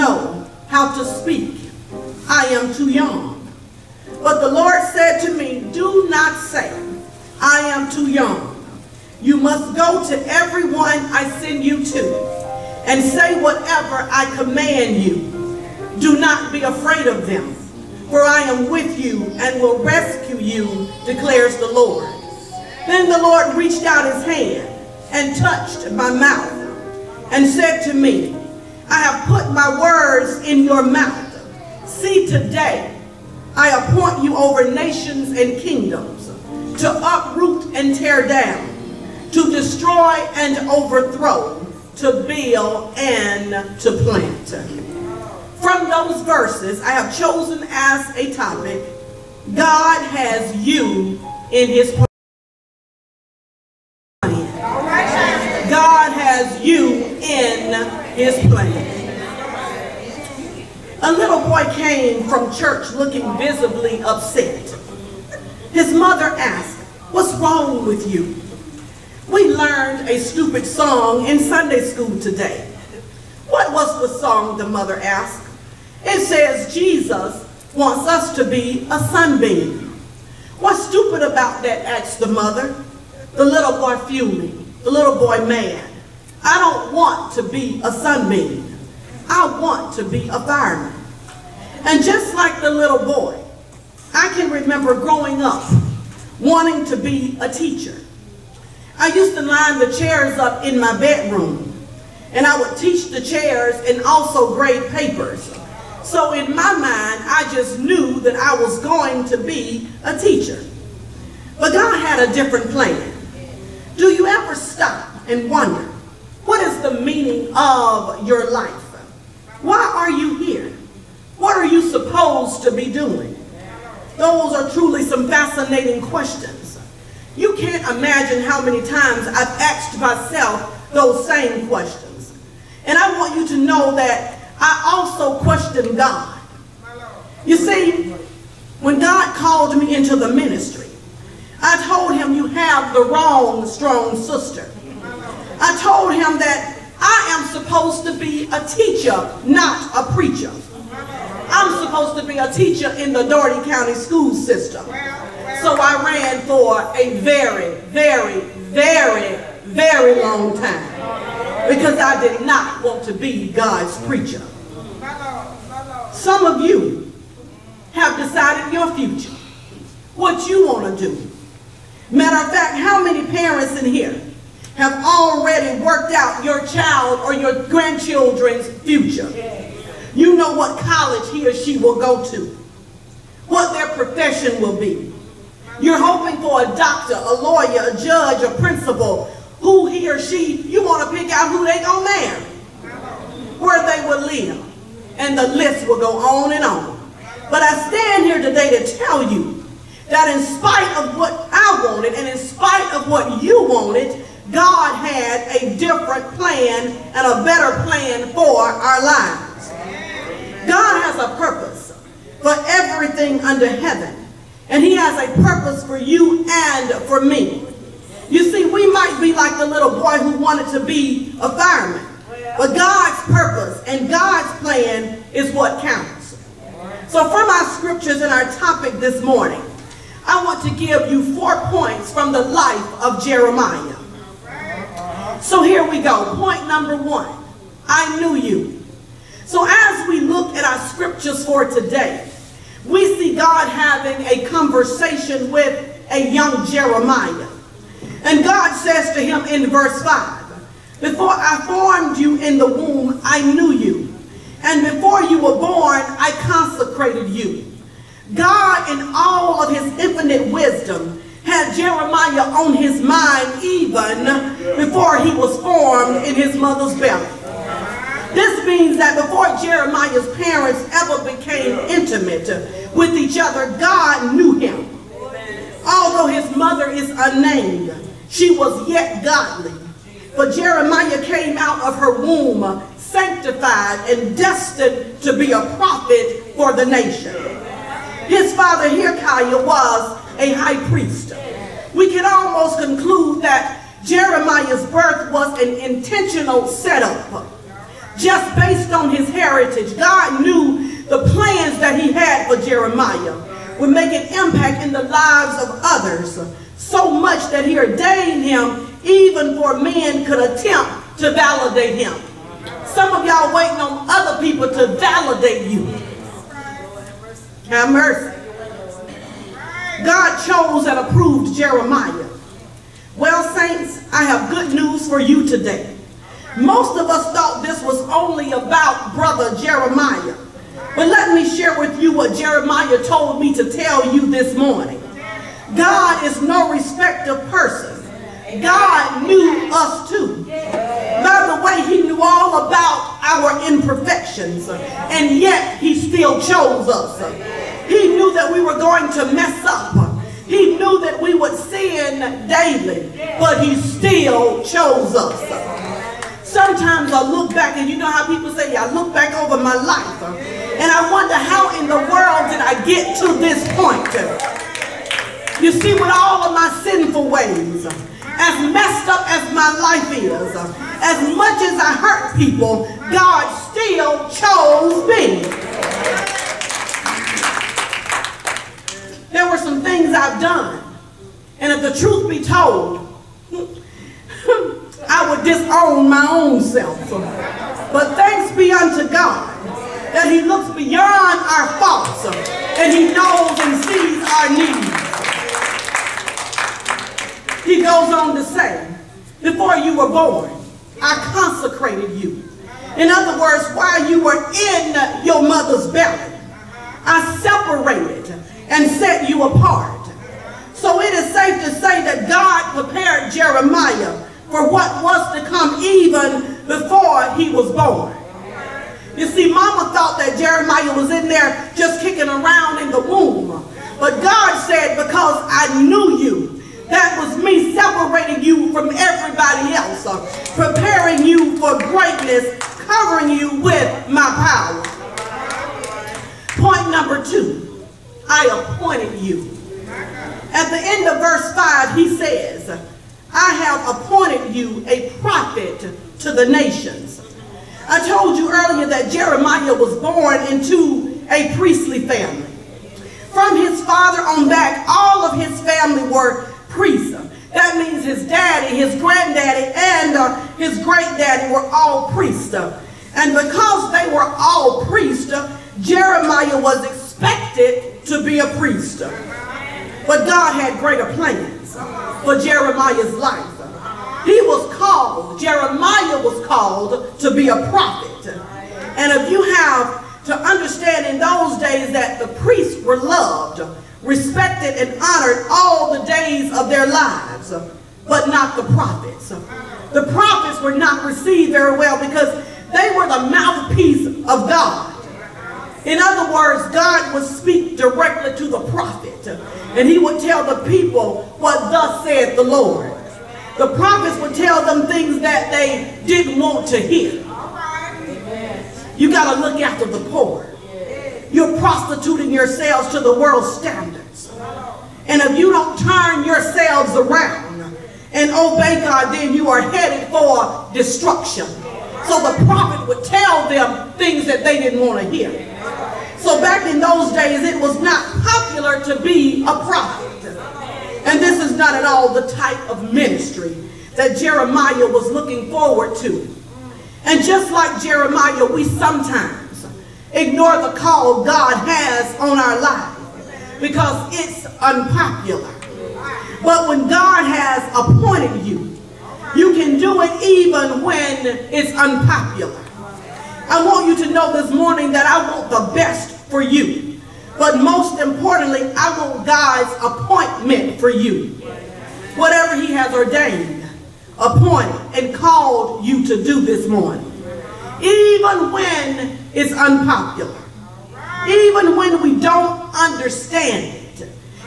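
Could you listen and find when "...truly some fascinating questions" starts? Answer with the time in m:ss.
2:04.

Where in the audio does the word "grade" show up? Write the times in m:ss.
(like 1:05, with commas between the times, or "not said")
1:44.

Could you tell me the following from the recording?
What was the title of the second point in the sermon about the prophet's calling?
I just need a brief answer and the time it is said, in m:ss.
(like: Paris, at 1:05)
I appointed you, at 7:18.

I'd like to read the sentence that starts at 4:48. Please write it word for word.
His father Hilkiah was a high priest.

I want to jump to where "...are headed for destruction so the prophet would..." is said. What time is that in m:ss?
8:39.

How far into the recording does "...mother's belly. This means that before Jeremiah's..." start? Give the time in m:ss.
4:26.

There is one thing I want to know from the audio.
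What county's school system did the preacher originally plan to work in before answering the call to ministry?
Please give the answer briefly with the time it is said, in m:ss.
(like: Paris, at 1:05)
Dougherty County, at 2:33.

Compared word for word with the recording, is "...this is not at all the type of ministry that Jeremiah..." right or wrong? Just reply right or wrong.
right.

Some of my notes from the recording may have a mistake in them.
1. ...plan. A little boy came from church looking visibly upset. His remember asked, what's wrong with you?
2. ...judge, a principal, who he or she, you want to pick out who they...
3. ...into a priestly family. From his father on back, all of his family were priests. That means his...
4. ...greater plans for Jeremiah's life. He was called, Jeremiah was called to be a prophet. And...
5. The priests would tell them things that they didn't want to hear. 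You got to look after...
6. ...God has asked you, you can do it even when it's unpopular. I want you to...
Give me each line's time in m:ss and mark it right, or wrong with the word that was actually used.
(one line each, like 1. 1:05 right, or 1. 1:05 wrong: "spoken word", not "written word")
1. 0:58 wrong: "mother", not "remember"
2. 3:07 right
3. 7:30 right
4. 7:50 right
5. 8:23 wrong: "prophets", not "priests"
6. 9:06 wrong: "appointed", not "asked".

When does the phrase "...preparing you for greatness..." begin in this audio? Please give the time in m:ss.
7:10.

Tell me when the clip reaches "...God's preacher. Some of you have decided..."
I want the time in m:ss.
2:43.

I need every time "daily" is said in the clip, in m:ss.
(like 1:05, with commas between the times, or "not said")
5:52.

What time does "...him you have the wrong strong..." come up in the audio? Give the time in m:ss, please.
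2:22.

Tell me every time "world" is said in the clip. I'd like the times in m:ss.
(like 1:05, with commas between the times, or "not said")
6:01, 8:33.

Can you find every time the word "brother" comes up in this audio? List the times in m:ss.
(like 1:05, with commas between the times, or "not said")
5:29.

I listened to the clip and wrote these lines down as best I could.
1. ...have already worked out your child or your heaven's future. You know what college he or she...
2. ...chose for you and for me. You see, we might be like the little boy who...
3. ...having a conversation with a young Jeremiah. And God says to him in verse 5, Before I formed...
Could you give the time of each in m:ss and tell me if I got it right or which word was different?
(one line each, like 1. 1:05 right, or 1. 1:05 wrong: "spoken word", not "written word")
1. 2:54 wrong: "grandchildren", not "heaven"
2. 3:35 wrong: "purpose", not "chose"
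3. 4:03 right.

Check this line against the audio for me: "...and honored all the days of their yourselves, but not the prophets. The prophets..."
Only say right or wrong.
wrong.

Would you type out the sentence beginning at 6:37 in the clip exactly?
He goes on to say, before you were born, I consecrated you.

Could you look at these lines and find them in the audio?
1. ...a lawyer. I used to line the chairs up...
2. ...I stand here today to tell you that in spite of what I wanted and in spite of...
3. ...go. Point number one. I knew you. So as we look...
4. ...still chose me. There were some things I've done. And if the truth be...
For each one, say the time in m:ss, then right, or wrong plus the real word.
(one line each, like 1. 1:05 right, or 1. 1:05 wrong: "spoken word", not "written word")
1. 1:37 wrong: "teacher", not "lawyer"
2. 3:17 right
3. 3:55 right
4. 6:13 right.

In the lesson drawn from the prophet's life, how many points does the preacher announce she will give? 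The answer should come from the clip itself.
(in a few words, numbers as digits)
4.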